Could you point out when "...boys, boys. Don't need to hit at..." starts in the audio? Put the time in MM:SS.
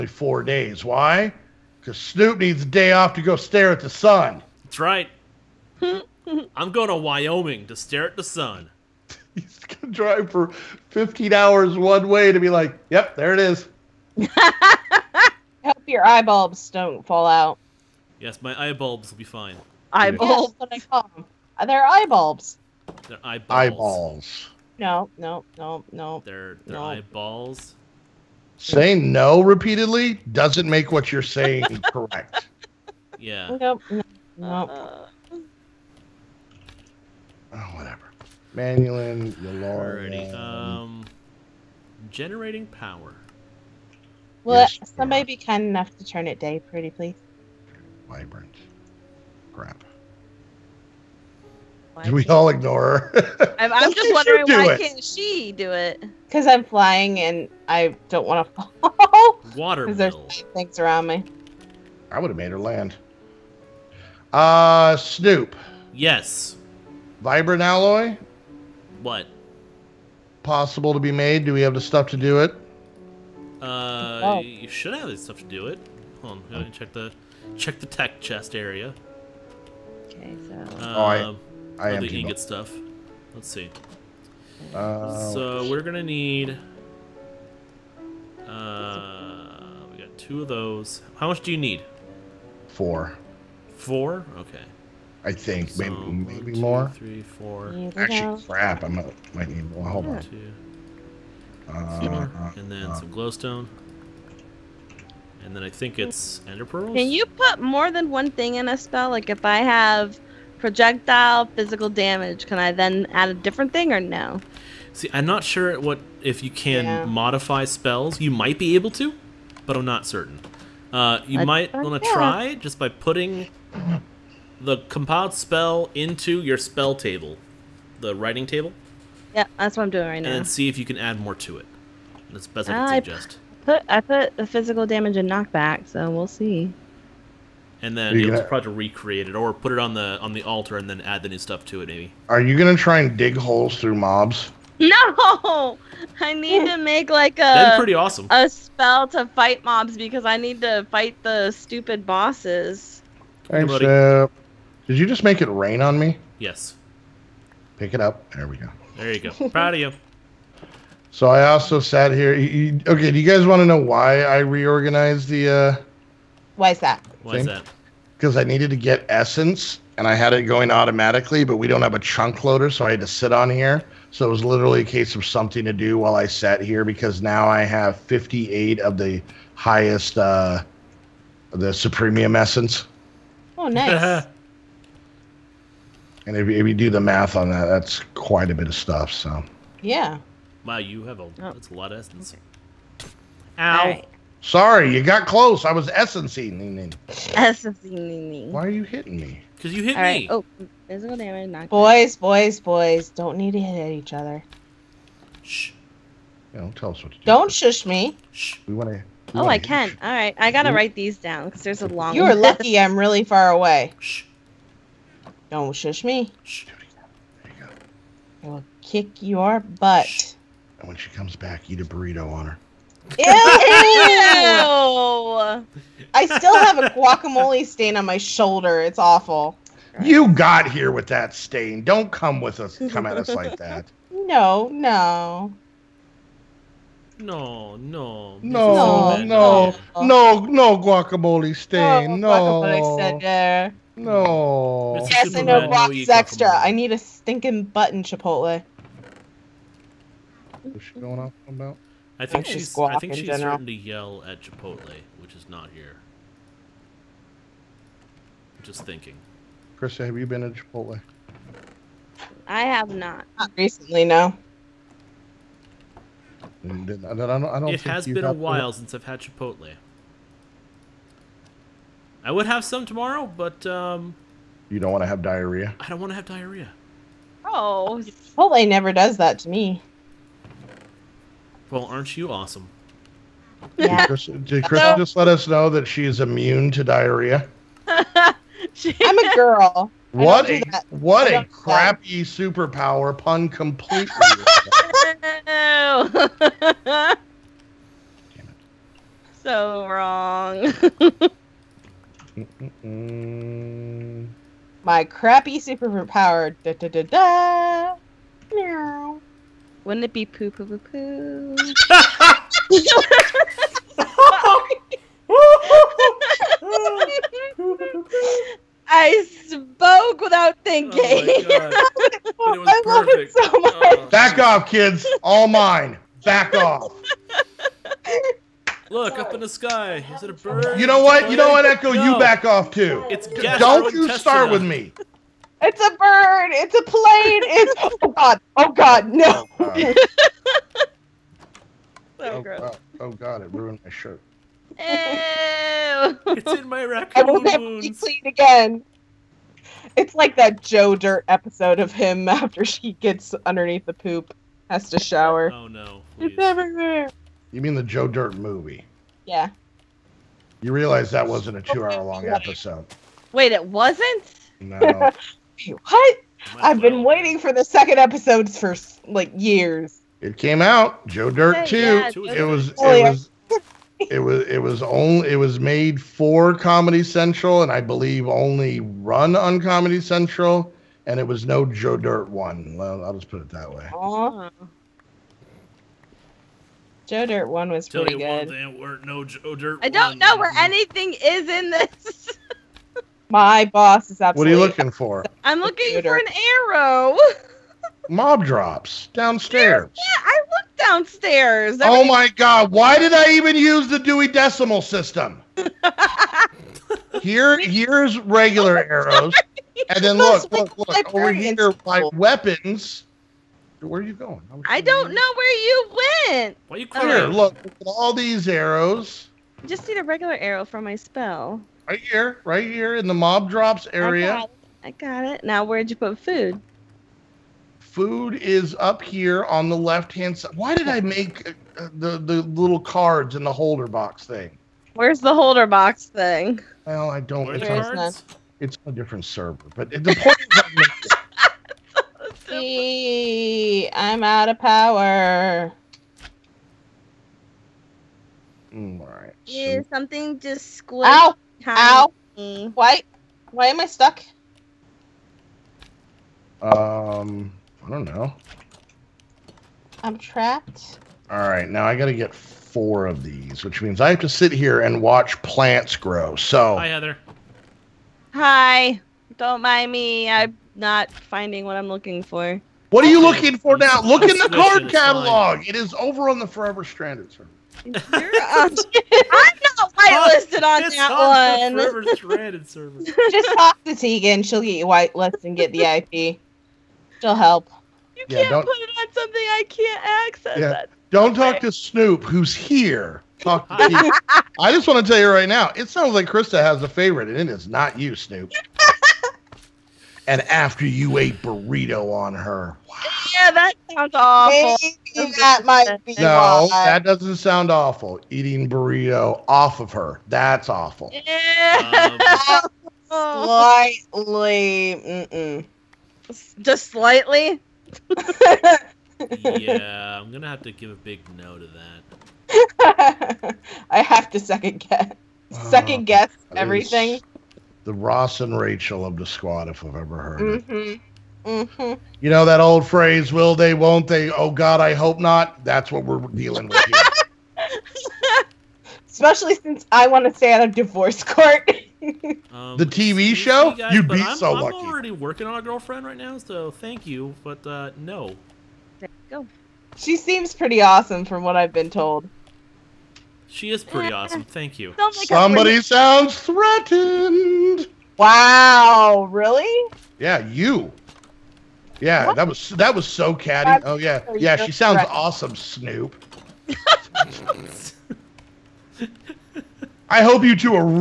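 03:22.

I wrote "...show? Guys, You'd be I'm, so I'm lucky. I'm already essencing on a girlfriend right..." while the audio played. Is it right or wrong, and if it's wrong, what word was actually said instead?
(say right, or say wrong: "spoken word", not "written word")
wrong: "working", not "essencing".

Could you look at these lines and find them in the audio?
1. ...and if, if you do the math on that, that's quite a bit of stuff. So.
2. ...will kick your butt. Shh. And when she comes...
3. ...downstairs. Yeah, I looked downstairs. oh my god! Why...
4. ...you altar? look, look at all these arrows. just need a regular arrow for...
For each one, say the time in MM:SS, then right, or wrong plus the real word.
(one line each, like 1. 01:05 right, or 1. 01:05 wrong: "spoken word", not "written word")
1. 03:06 right
2. 03:38 right
3. 06:39 right
4. 06:56 wrong: "clear", not "altar".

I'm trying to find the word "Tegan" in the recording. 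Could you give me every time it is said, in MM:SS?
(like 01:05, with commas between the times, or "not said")
08:03, 08:13.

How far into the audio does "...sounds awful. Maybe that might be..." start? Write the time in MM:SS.
08:23.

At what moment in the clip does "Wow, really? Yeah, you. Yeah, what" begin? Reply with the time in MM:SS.
09:18.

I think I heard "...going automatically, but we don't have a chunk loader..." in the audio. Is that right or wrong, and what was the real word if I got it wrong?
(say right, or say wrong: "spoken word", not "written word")
right.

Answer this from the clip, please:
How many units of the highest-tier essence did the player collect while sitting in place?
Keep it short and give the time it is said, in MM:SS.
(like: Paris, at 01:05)
58, at 02:57.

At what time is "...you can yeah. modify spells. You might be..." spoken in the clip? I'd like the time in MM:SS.
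01:56.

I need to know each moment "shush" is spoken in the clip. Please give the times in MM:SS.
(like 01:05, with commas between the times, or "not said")
03:27, 03:35.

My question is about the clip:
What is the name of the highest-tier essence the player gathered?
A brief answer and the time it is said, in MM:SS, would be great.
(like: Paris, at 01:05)
supremium essence, at 03:01.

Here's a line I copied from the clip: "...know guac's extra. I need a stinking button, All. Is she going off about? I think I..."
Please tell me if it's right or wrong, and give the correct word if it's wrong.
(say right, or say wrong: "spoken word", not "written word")
wrong: "Chipotle", not "All".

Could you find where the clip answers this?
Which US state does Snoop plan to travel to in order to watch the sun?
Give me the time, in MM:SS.
00:06.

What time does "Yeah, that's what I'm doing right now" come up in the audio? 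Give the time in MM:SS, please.
02:09.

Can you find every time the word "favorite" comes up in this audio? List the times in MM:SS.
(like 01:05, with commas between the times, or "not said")
08:16.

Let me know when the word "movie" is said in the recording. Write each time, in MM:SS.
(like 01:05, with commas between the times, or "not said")
05:58.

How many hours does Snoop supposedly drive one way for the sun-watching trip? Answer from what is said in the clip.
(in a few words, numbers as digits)
15.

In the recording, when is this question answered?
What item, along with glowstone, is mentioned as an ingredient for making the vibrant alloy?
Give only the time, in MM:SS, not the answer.
01:46.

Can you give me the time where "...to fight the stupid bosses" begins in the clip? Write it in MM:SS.
02:30.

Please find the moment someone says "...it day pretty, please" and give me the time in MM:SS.
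00:46.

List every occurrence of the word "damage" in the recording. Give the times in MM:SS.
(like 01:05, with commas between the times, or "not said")
01:51, 02:14, 03:21.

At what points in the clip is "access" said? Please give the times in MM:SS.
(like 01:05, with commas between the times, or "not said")
08:10.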